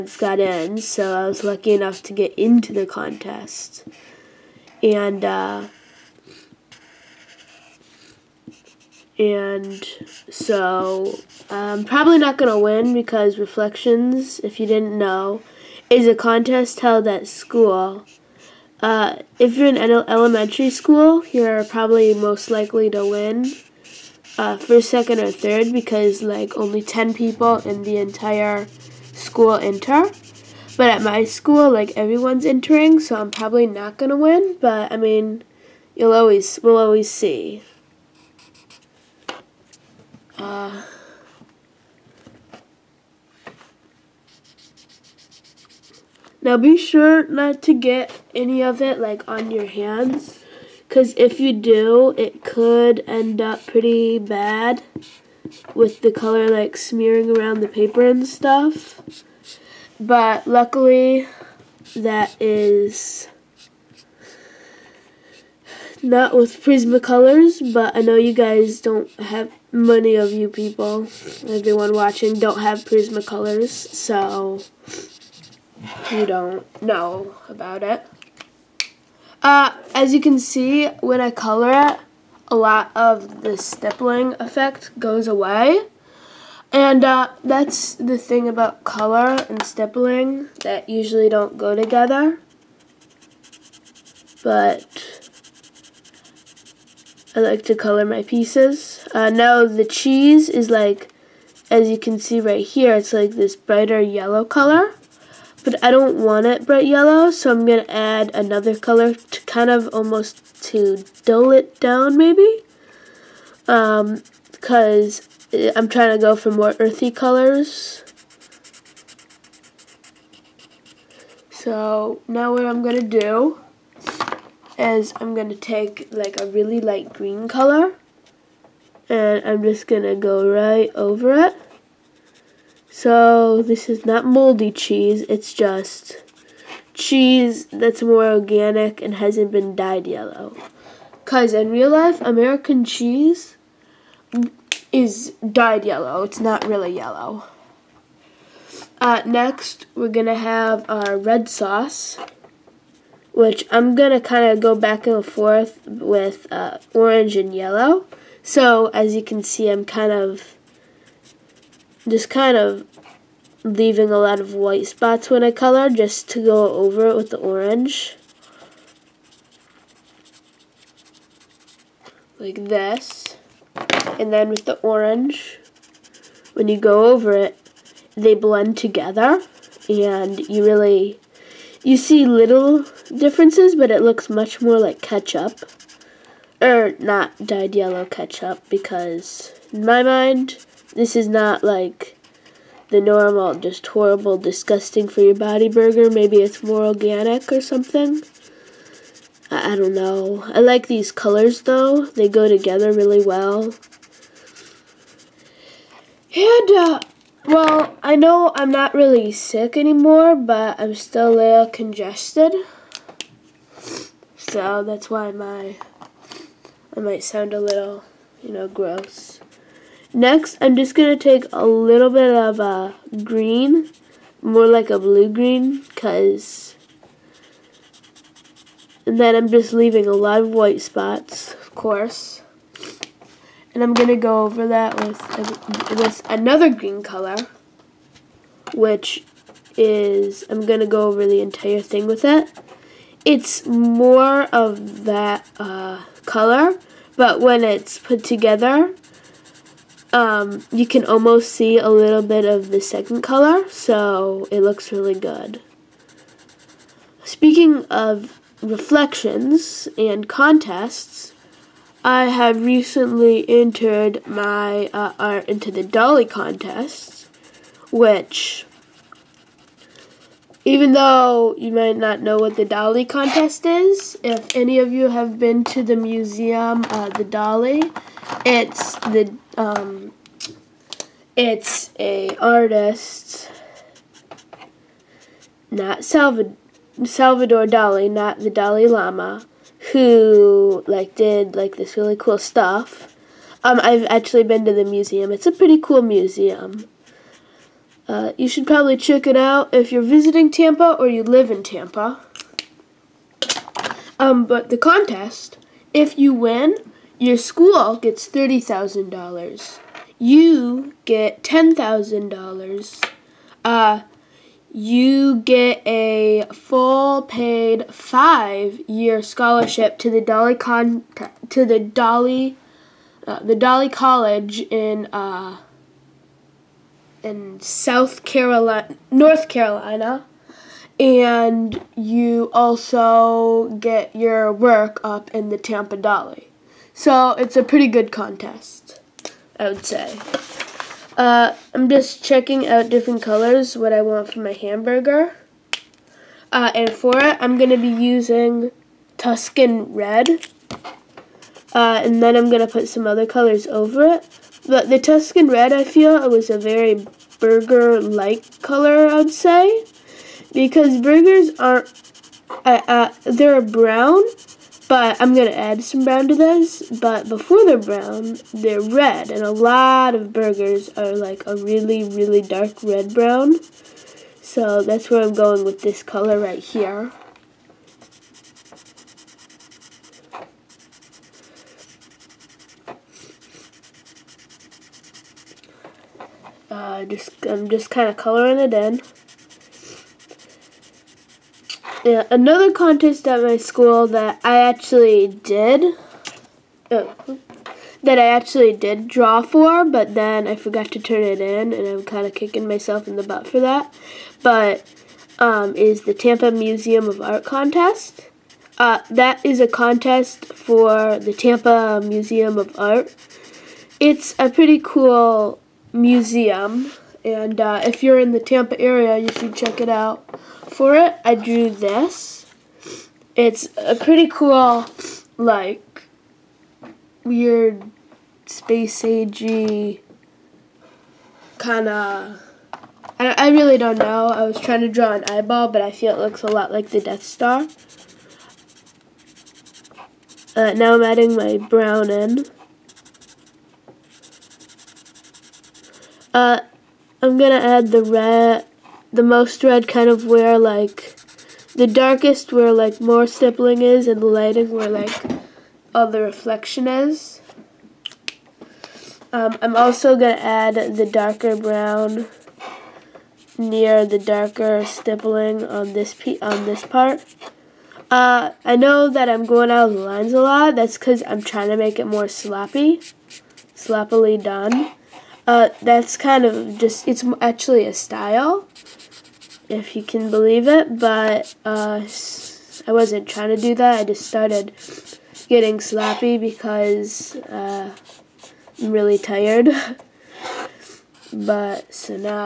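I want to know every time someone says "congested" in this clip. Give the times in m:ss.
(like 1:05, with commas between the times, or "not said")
3:31.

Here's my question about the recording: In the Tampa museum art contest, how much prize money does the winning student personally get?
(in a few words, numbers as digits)
$10,000.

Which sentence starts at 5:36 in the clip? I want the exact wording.
So it's a pretty good contest, I would say.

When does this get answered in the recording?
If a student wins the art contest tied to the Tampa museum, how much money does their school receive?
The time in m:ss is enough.
5:08.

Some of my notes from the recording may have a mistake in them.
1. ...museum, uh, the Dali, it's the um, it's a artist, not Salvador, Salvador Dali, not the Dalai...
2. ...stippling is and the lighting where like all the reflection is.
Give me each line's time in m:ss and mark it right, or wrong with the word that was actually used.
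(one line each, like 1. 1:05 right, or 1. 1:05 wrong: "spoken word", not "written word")
1. 4:35 right
2. 7:33 right.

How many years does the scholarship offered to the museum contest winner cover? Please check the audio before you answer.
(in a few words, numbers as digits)
5 years.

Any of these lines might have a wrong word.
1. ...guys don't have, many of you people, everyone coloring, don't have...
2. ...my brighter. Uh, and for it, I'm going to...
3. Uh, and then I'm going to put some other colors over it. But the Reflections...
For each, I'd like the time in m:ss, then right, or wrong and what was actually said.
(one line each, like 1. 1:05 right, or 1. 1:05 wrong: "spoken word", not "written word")
1. 1:08 wrong: "watching", not "coloring"
2. 5:44 wrong: "hamburger", not "brighter"
3. 5:51 wrong: "Tuscan", not "Reflections".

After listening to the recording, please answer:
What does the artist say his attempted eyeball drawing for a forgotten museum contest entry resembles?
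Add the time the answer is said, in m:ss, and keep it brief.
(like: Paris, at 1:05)
The Death Star, at 7:16.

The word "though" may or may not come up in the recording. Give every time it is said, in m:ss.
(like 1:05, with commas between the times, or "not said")
3:21, 4:30.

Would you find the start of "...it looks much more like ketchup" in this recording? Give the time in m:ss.
3:03.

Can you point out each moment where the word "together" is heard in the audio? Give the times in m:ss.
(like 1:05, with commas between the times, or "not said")
1:31, 2:58, 3:22, 4:08.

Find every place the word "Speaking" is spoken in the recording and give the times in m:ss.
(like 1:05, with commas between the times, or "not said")
4:17.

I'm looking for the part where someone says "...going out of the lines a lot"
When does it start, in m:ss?
7:49.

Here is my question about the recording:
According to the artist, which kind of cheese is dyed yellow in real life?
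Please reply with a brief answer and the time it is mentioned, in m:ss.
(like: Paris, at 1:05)
American cheese, at 2:22.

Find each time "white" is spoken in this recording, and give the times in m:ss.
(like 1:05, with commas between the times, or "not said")
2:44, 3:50.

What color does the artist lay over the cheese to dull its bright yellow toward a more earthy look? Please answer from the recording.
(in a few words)
Light green.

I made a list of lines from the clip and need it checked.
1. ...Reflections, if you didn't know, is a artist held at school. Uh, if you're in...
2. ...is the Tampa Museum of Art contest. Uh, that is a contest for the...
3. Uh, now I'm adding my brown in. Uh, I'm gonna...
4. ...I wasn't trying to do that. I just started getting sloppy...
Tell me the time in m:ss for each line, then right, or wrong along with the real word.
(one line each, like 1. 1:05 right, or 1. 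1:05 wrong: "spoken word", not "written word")
1. 0:13 wrong: "contest", not "artist"
2. 6:45 right
3. 7:20 right
4. 8:02 right.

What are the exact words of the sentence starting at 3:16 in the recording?
Maybe it's more organic or something.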